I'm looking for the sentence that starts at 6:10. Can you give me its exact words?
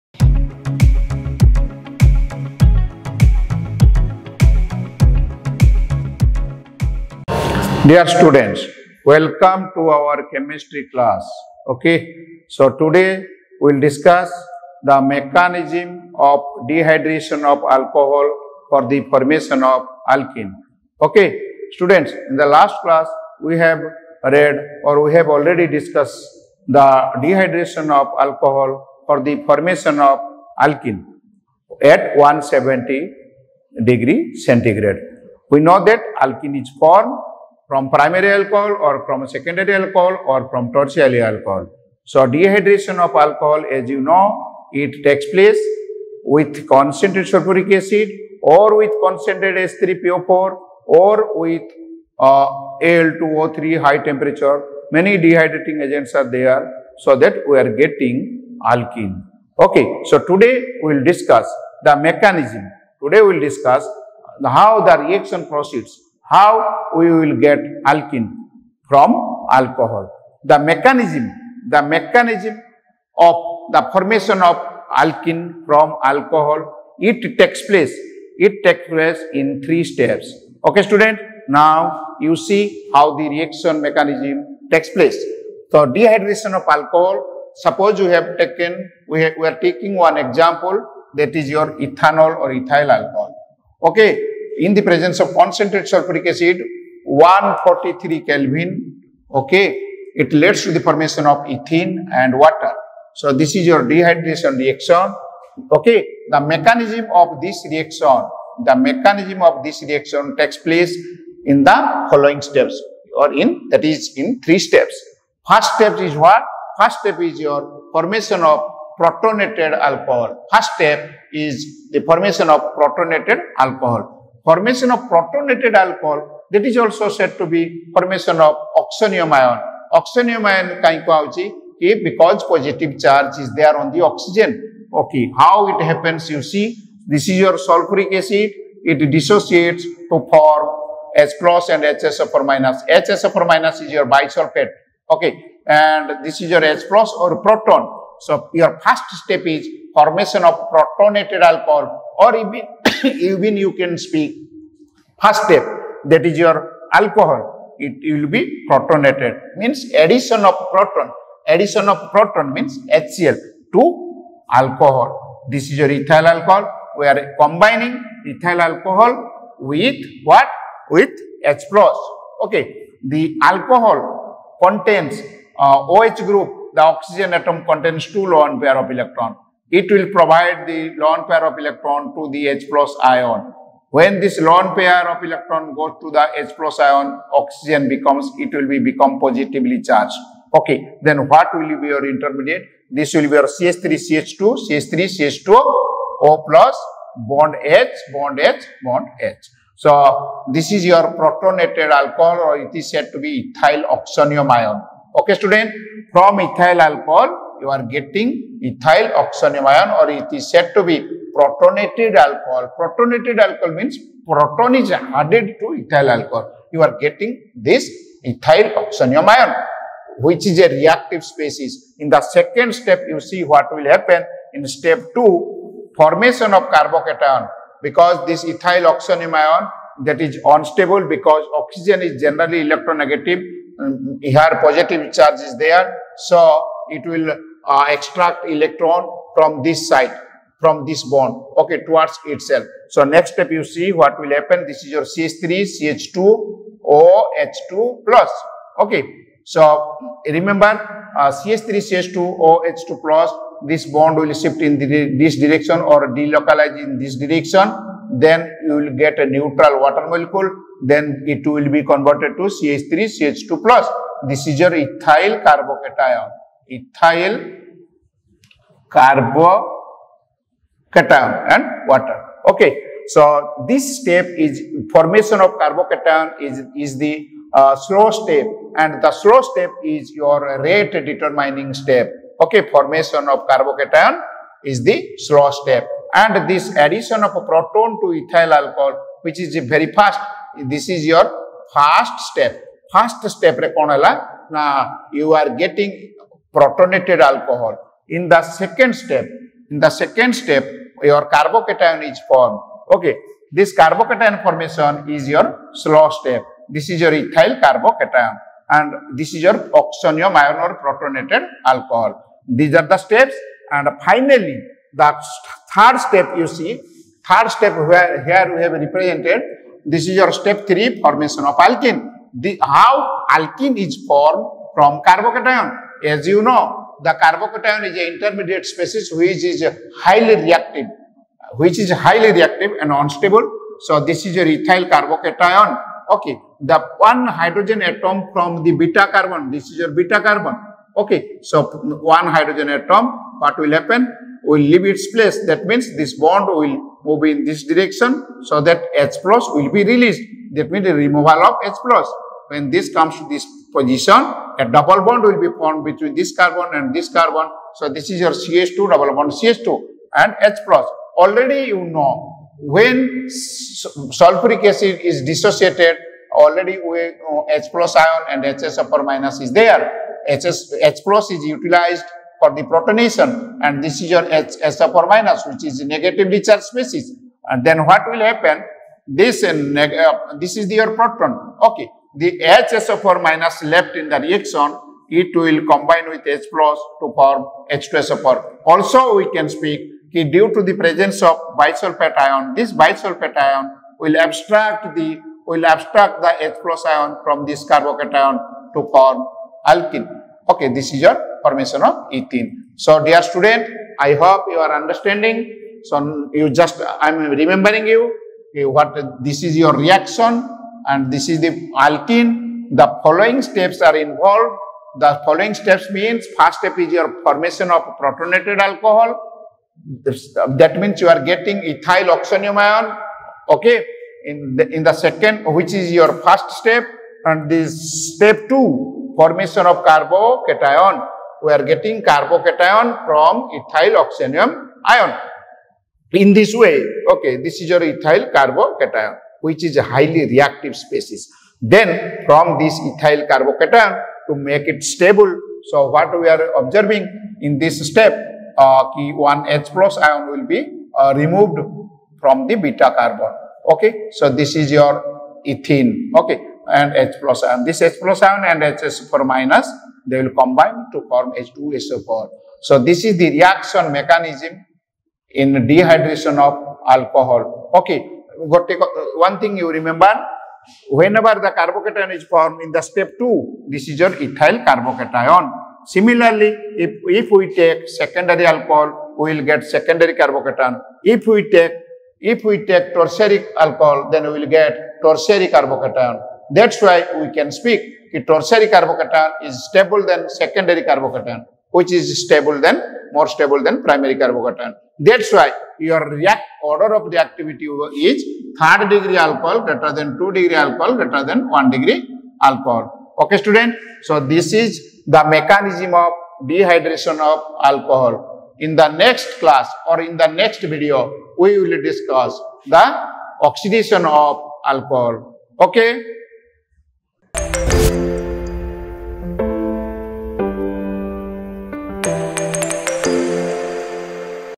HS, H plus is utilized for the protonation and this is your H, S upper minus which is negatively charged species.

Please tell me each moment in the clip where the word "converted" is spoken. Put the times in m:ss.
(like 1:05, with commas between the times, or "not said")
4:21.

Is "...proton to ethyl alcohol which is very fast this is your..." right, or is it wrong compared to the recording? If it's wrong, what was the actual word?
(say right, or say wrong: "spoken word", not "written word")
right.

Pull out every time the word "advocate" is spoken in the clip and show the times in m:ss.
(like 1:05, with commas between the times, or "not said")
not said.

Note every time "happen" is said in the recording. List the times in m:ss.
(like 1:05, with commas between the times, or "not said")
2:15, 3:43, 4:04, 5:43, 6:18.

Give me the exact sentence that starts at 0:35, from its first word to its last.
We know that alkene is formed from primary alcohol or from secondary alcohol or from tertiary alcohol.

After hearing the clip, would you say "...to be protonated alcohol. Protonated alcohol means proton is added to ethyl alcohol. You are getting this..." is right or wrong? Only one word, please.
right.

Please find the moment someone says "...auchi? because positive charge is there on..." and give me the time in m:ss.
2:11.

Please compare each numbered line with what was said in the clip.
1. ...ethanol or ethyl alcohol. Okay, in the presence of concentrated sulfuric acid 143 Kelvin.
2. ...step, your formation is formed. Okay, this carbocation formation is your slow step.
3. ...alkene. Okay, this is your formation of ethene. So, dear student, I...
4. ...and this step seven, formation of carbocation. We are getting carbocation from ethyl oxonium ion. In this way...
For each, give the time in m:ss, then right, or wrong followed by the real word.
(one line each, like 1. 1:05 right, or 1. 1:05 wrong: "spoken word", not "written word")
1. 1:31 right
2. 5:00 wrong: "carbocation", not "formation"
3. 6:39 right
4. 7:07 wrong: "two", not "seven".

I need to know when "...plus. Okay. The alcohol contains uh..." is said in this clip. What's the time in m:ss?
2:51.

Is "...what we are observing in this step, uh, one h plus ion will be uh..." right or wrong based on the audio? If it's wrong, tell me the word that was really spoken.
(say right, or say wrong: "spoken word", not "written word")
right.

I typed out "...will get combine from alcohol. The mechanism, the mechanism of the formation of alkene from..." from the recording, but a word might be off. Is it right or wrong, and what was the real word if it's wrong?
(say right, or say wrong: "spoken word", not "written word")
wrong: "alkene", not "combine".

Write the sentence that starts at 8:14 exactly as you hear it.
That's why your react order of reactivity is third degree alcohol greater than 2 degree alcohol greater than 1 degree alcohol.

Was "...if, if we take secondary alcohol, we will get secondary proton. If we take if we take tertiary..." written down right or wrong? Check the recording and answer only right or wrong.
wrong.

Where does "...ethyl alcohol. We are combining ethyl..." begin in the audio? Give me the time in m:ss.
2:45.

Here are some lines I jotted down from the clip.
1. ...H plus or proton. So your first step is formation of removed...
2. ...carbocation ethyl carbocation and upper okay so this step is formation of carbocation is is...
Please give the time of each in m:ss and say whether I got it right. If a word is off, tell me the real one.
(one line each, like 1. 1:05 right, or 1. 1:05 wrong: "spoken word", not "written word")
1. 2:26 wrong: "protonated", not "removed"
2. 4:25 wrong: "water", not "upper".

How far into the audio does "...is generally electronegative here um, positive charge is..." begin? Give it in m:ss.
3:52.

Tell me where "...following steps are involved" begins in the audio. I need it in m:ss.
6:53.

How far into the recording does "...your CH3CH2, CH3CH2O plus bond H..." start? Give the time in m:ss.
3:13.